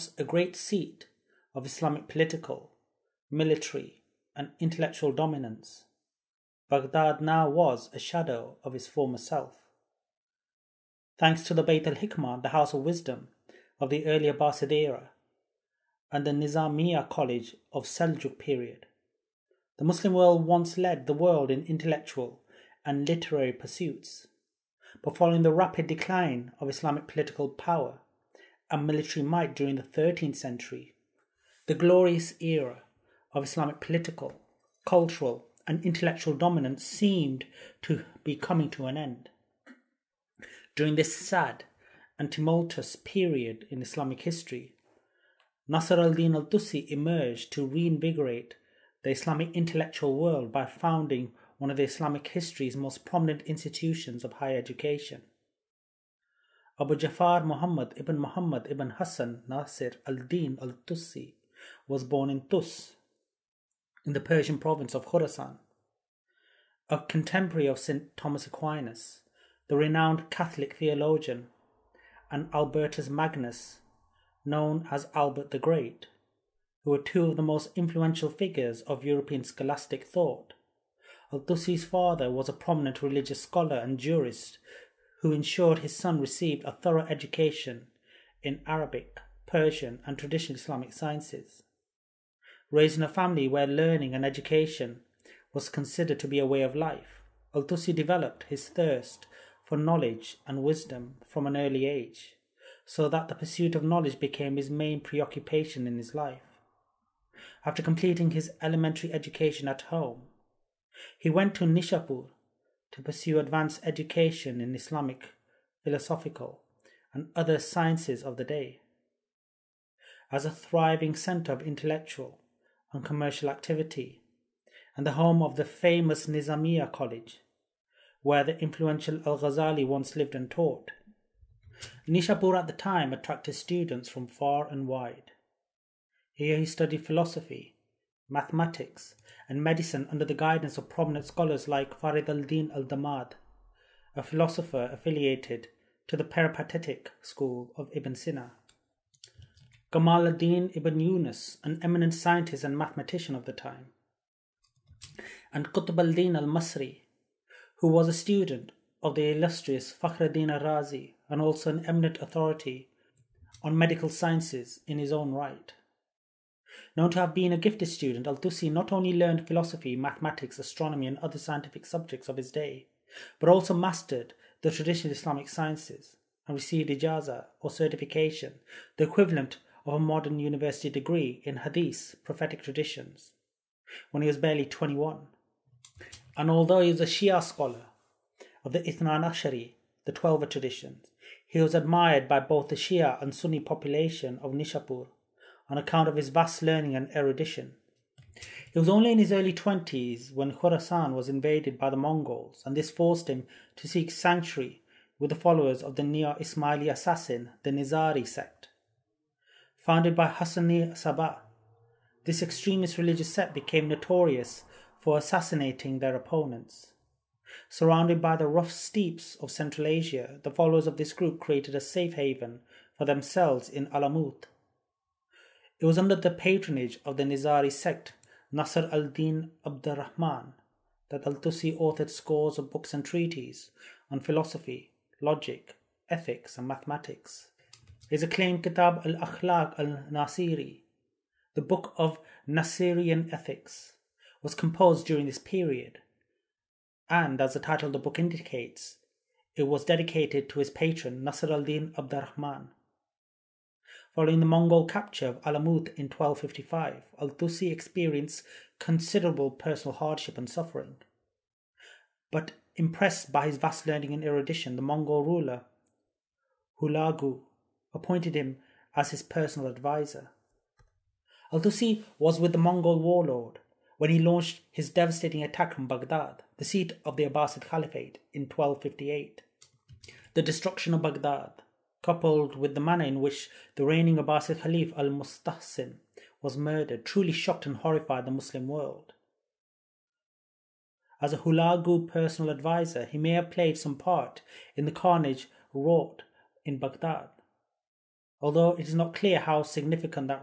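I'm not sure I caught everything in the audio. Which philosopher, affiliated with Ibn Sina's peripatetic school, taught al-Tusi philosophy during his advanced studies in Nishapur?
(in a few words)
Farid al Din al Damad.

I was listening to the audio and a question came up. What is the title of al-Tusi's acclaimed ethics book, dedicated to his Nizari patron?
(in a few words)
Kitab al Akhlaq al Nasiri.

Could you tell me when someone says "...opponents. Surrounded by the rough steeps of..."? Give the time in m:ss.
3:36.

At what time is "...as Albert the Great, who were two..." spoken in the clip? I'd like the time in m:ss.
1:14.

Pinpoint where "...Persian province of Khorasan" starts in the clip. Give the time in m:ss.
1:04.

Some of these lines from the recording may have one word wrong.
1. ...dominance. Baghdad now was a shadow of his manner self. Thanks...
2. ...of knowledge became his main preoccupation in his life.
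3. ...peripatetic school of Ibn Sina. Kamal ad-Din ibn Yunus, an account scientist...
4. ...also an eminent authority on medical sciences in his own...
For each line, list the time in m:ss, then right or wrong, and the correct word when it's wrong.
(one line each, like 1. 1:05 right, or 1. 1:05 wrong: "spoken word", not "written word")
1. 0:05 wrong: "former", not "manner"
2. 1:43 right
3. 2:26 wrong: "eminent", not "account"
4. 2:41 right.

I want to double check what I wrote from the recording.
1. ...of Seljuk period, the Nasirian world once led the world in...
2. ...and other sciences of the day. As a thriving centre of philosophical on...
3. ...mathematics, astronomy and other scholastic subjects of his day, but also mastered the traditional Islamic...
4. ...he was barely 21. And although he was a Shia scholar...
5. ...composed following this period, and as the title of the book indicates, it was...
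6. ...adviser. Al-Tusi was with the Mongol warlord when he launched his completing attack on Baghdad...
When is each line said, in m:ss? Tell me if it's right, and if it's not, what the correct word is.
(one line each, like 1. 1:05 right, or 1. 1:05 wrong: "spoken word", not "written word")
1. 0:17 wrong: "Muslim", not "Nasirian"
2. 1:57 wrong: "intellectual", not "philosophical"
3. 2:49 wrong: "scientific", not "scholastic"
4. 3:04 right
5. 4:04 wrong: "during", not "following"
6. 4:29 wrong: "devastating", not "completing".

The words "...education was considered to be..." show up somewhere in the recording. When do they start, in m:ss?
1:34.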